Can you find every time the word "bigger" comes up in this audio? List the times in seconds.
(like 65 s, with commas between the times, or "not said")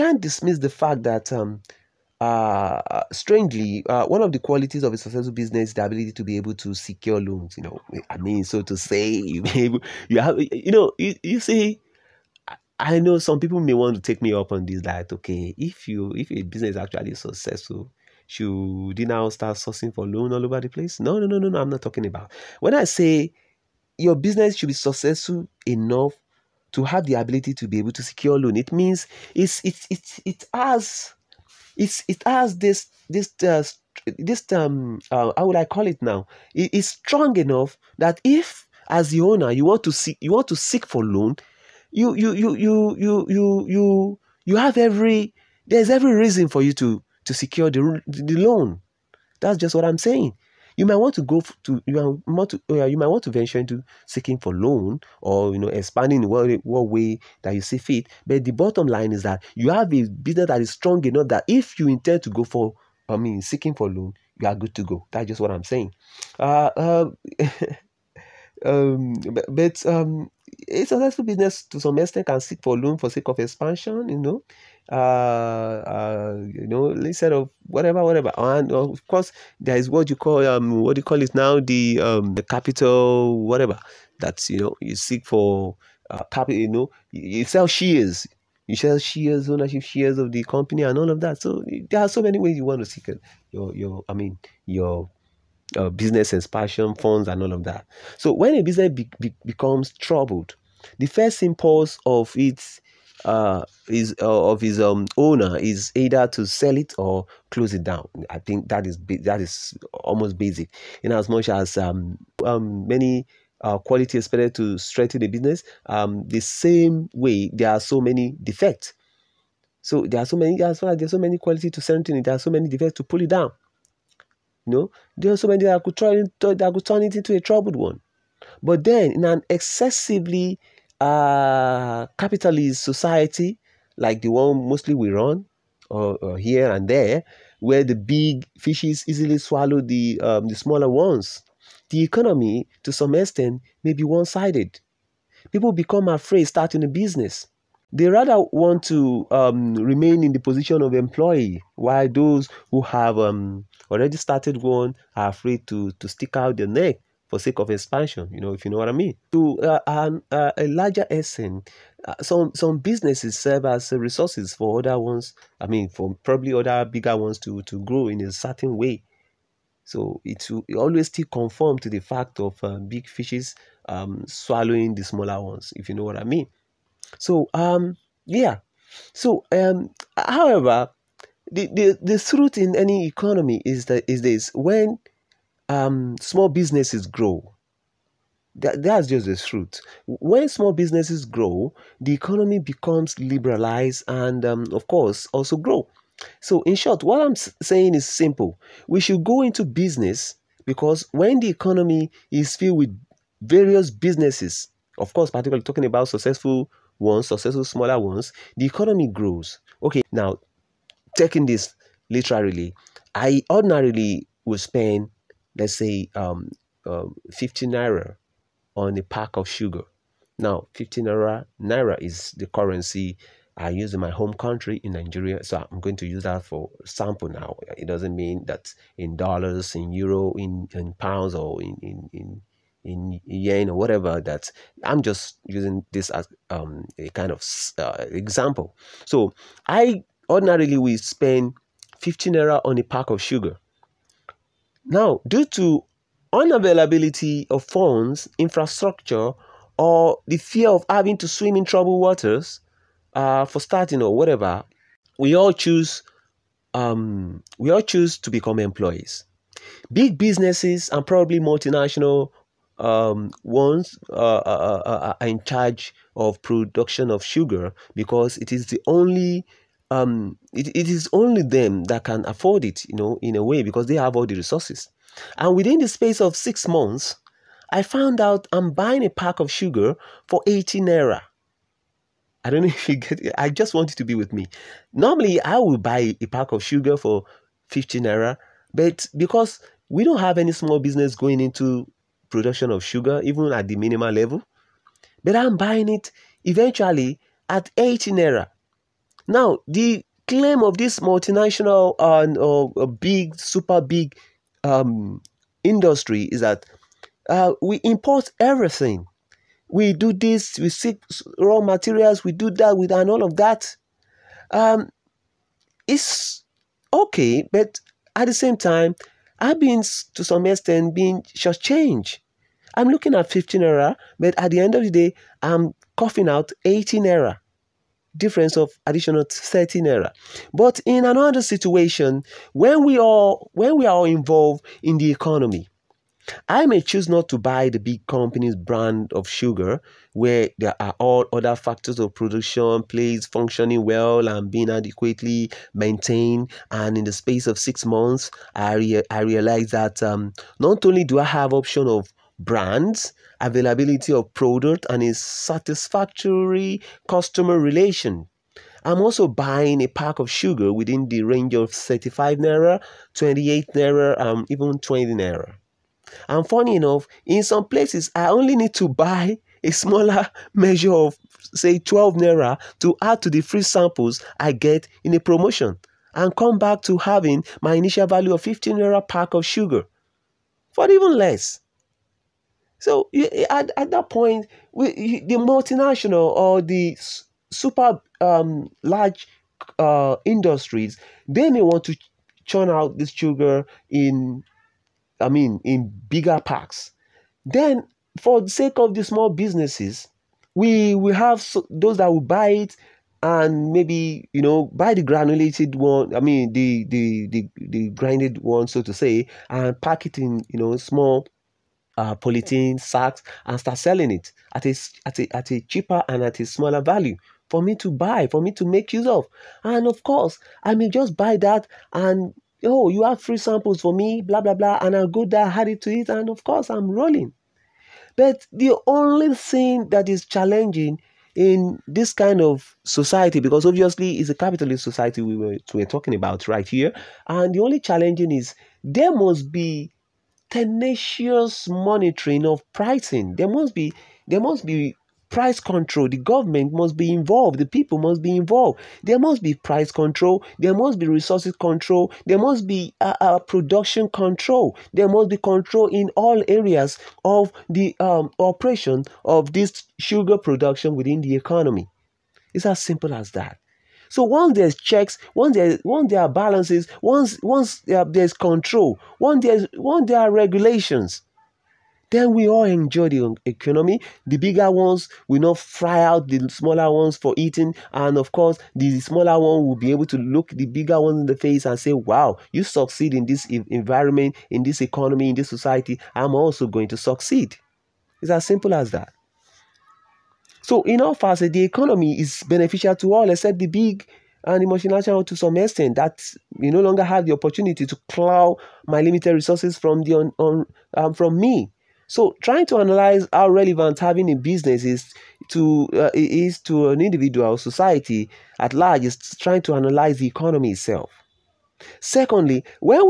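166 s, 396 s, 474 s, 480 s.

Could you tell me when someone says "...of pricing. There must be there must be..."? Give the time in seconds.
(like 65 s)
442 s.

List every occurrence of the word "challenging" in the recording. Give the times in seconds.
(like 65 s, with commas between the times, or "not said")
430 s, 437 s.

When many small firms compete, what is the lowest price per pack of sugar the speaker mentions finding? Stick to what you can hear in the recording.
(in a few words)
20 naira.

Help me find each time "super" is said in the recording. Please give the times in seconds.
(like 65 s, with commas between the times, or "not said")
303 s, 387 s.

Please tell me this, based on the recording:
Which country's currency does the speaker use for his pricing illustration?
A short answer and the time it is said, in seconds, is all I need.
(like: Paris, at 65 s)
Nigeria, at 224 s.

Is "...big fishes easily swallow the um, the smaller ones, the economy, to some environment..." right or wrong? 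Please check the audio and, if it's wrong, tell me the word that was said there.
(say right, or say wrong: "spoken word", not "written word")
wrong: "extent", not "environment".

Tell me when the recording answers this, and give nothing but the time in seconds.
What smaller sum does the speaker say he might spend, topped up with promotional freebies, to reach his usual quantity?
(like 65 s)
371 s.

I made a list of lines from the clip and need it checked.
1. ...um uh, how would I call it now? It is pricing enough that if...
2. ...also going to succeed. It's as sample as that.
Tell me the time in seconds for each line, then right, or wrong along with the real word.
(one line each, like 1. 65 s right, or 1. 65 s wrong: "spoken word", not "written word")
1. 34 s wrong: "strong", not "pricing"
2. 486 s wrong: "simple", not "sample".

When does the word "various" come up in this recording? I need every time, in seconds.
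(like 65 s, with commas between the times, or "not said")
203 s.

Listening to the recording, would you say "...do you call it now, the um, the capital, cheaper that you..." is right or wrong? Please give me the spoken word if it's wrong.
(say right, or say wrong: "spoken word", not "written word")
wrong: "whatever", not "cheaper".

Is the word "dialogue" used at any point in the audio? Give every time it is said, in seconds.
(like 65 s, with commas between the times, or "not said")
not said.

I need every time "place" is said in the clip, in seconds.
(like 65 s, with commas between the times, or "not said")
20 s, 367 s.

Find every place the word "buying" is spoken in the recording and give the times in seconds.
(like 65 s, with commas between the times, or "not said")
278 s, 295 s, 359 s.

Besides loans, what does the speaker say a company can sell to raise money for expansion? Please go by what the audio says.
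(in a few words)
ownership shares.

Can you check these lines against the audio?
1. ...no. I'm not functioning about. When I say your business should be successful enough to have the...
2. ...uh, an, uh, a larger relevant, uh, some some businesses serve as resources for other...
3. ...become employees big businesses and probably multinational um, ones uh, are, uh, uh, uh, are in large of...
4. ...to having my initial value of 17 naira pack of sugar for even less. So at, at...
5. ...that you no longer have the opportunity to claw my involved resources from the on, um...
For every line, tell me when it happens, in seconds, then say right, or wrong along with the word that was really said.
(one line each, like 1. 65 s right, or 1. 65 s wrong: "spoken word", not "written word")
1. 21 s wrong: "talking", not "functioning"
2. 159 s wrong: "extent", not "relevant"
3. 258 s wrong: "charge", not "large"
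4. 376 s wrong: "15", not "17"
5. 495 s wrong: "limited", not "involved".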